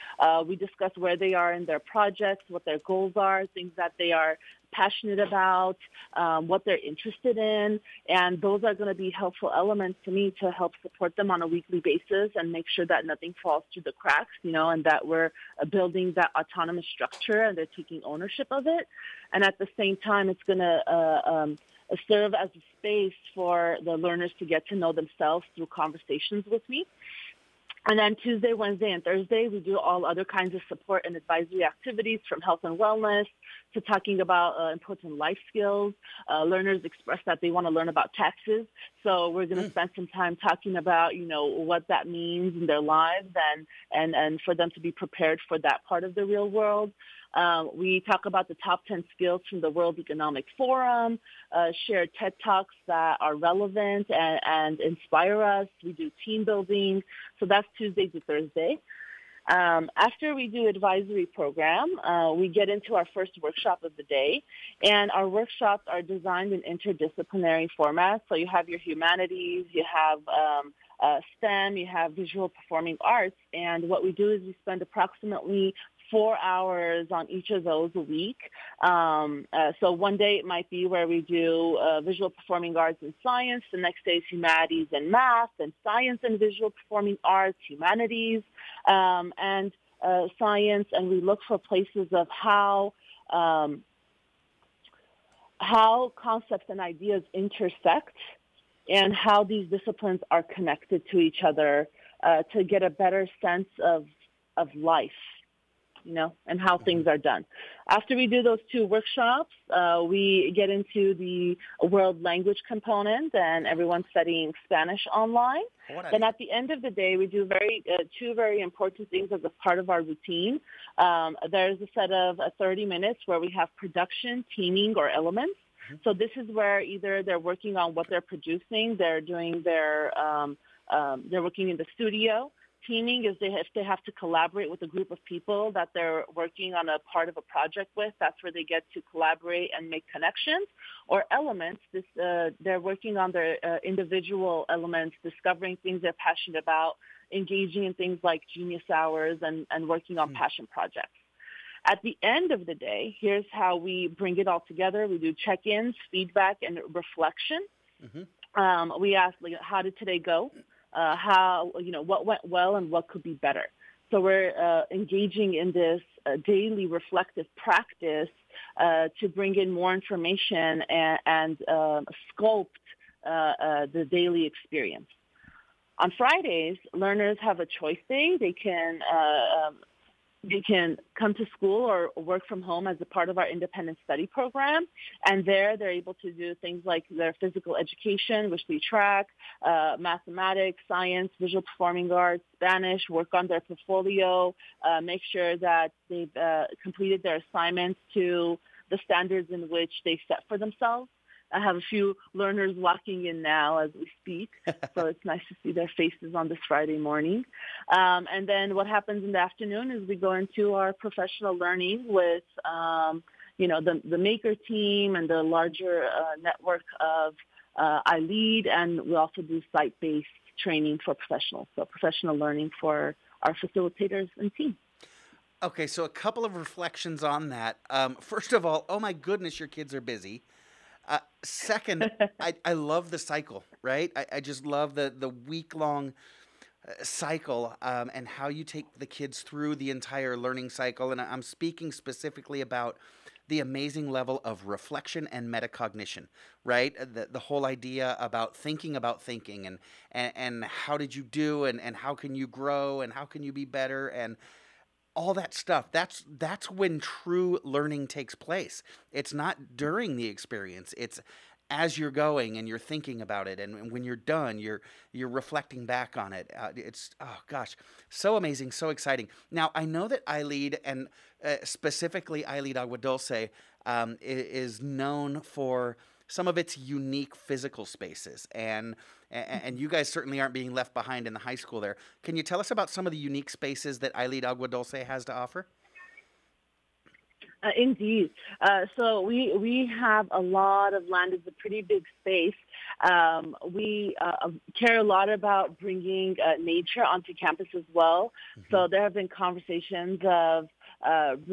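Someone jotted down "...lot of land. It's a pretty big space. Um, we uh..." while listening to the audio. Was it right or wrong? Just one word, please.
right.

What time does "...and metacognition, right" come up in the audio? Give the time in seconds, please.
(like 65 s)
245 s.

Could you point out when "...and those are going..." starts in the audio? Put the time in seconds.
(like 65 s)
8 s.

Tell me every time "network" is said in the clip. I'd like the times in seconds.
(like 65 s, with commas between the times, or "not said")
216 s.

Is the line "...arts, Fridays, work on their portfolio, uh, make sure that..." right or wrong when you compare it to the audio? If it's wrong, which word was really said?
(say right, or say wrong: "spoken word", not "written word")
wrong: "Spanish", not "Fridays".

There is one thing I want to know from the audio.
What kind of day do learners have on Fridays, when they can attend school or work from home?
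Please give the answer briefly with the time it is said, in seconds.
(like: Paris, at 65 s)
Choice day, at 177 s.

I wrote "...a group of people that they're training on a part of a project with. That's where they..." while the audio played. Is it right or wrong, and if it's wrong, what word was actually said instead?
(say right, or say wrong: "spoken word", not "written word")
wrong: "working", not "training".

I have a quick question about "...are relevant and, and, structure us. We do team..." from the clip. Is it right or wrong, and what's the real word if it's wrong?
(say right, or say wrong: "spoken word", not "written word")
wrong: "inspire", not "structure".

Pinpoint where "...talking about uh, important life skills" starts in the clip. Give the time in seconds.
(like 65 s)
33 s.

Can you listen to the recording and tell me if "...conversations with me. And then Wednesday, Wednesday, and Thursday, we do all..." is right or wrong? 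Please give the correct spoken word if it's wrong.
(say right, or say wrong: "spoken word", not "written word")
wrong: "Tuesday", not "Wednesday".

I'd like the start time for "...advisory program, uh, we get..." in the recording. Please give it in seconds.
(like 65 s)
60 s.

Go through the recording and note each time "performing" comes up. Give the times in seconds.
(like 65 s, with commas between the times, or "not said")
72 s, 82 s, 86 s, 191 s.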